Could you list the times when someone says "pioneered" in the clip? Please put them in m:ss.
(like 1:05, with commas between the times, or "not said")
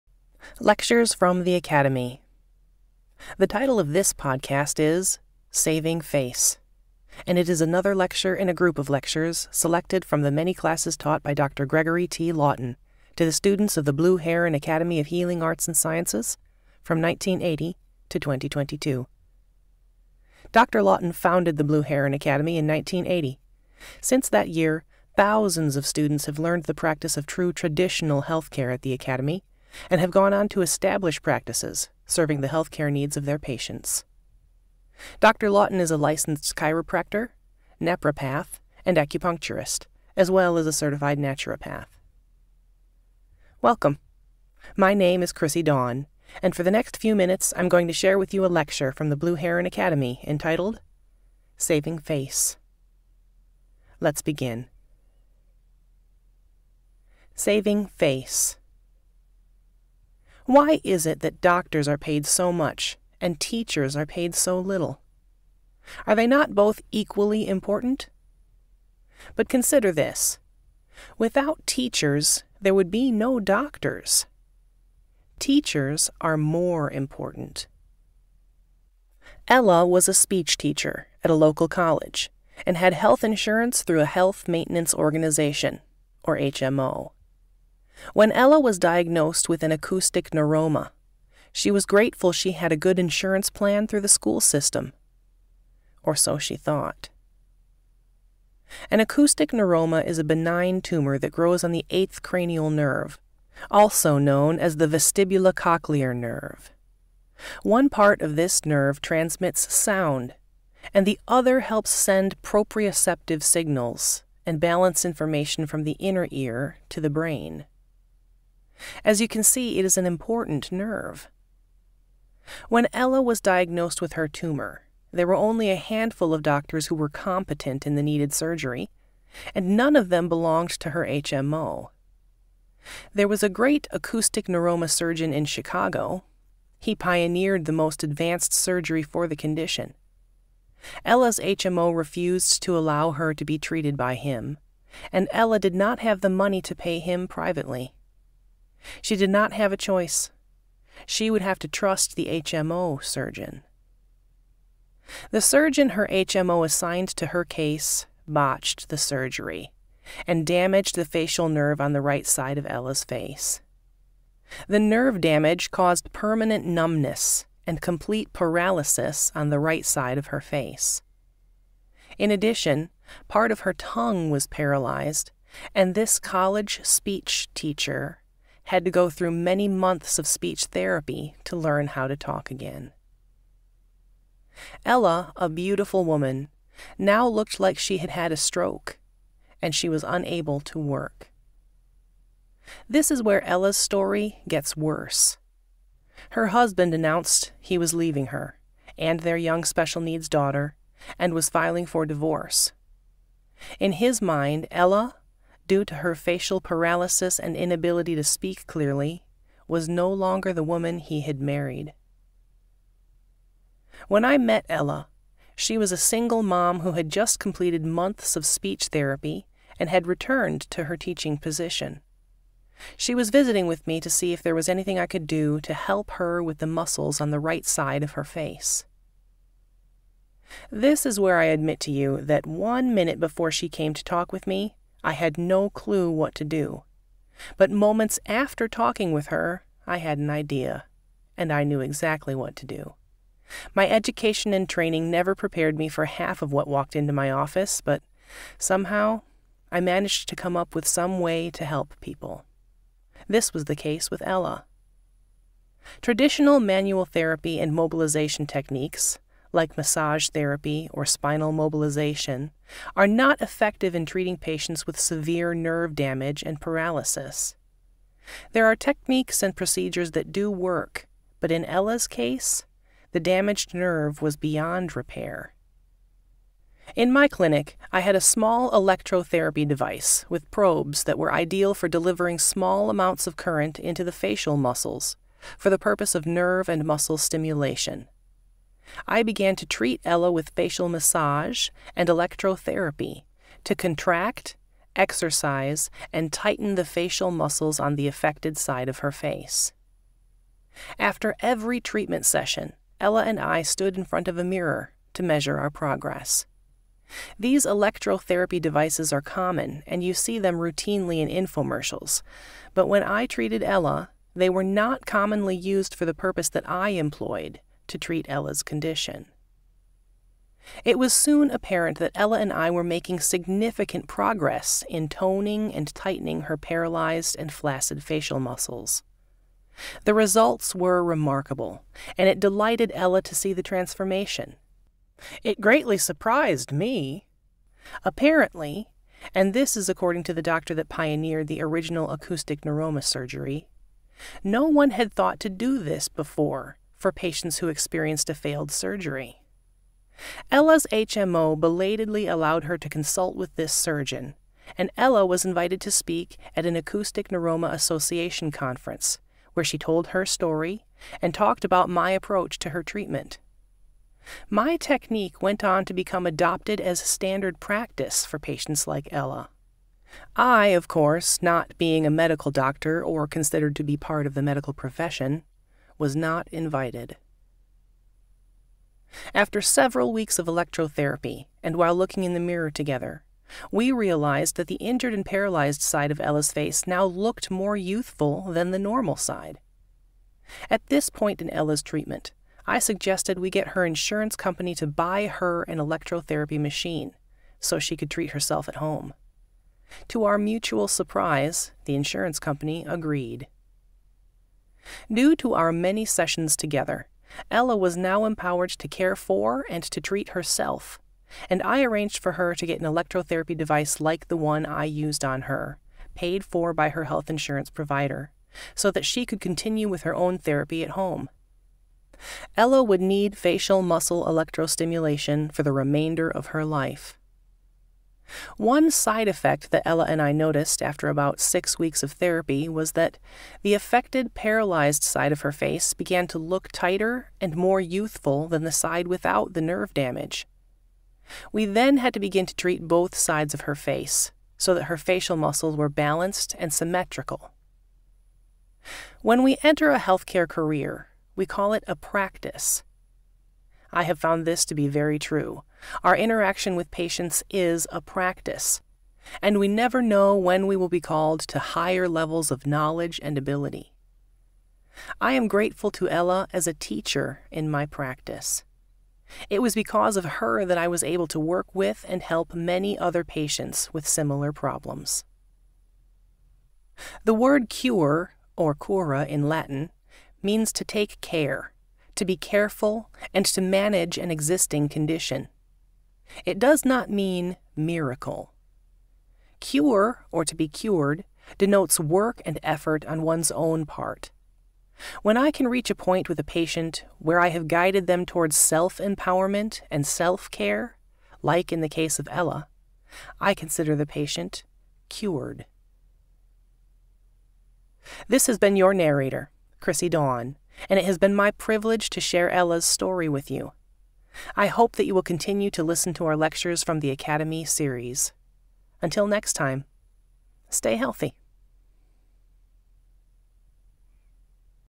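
2:16, 5:40.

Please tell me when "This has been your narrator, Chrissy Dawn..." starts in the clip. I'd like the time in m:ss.
8:28.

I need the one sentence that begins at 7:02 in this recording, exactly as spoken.
Ella would need facial muscle electrostimulation for the remainder of her life.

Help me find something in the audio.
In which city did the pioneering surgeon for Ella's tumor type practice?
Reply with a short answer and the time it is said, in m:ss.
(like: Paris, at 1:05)
Chicago, at 2:15.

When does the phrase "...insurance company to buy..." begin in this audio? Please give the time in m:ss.
6:33.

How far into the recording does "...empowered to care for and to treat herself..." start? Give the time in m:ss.
6:48.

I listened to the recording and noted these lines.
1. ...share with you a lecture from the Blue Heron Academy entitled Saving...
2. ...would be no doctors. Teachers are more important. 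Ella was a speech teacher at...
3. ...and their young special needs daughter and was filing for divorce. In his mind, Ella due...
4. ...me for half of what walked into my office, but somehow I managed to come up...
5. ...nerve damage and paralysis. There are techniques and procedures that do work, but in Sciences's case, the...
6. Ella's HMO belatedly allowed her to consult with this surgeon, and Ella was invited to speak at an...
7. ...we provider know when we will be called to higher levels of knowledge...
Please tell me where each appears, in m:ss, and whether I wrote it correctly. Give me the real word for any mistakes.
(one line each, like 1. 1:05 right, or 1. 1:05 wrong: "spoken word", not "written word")
1. 0:47 right
2. 1:12 right
3. 3:18 right
4. 4:05 right
5. 4:25 wrong: "Ella", not "Sciences"
6. 5:50 right
7. 7:39 wrong: "never", not "provider".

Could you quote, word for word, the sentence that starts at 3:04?
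Ella, a beautiful woman, now looked like she had had a stroke, and she was unable to work.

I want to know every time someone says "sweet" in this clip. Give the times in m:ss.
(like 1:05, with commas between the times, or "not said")
not said.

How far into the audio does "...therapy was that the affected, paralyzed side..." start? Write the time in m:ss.
7:12.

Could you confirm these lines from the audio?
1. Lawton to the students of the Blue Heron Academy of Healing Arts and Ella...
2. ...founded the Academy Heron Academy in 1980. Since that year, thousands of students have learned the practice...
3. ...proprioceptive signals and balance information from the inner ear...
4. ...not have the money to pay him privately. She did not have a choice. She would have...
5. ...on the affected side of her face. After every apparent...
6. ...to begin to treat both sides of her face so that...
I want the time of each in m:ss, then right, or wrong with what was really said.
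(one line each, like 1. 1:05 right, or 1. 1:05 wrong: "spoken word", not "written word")
1. 0:12 wrong: "Sciences", not "Ella"
2. 0:21 wrong: "Blue", not "Academy"
3. 1:52 right
4. 2:25 right
5. 4:57 wrong: "treatment", not "apparent"
6. 7:22 right.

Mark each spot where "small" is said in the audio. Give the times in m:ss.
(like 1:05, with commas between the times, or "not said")
4:38, 4:42.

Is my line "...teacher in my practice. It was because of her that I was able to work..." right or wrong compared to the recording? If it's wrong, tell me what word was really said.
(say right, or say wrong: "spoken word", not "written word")
right.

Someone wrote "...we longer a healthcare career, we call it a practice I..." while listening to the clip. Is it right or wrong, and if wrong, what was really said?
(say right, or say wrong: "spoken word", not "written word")
wrong: "enter", not "longer".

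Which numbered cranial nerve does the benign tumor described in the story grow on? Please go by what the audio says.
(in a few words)
Eighth.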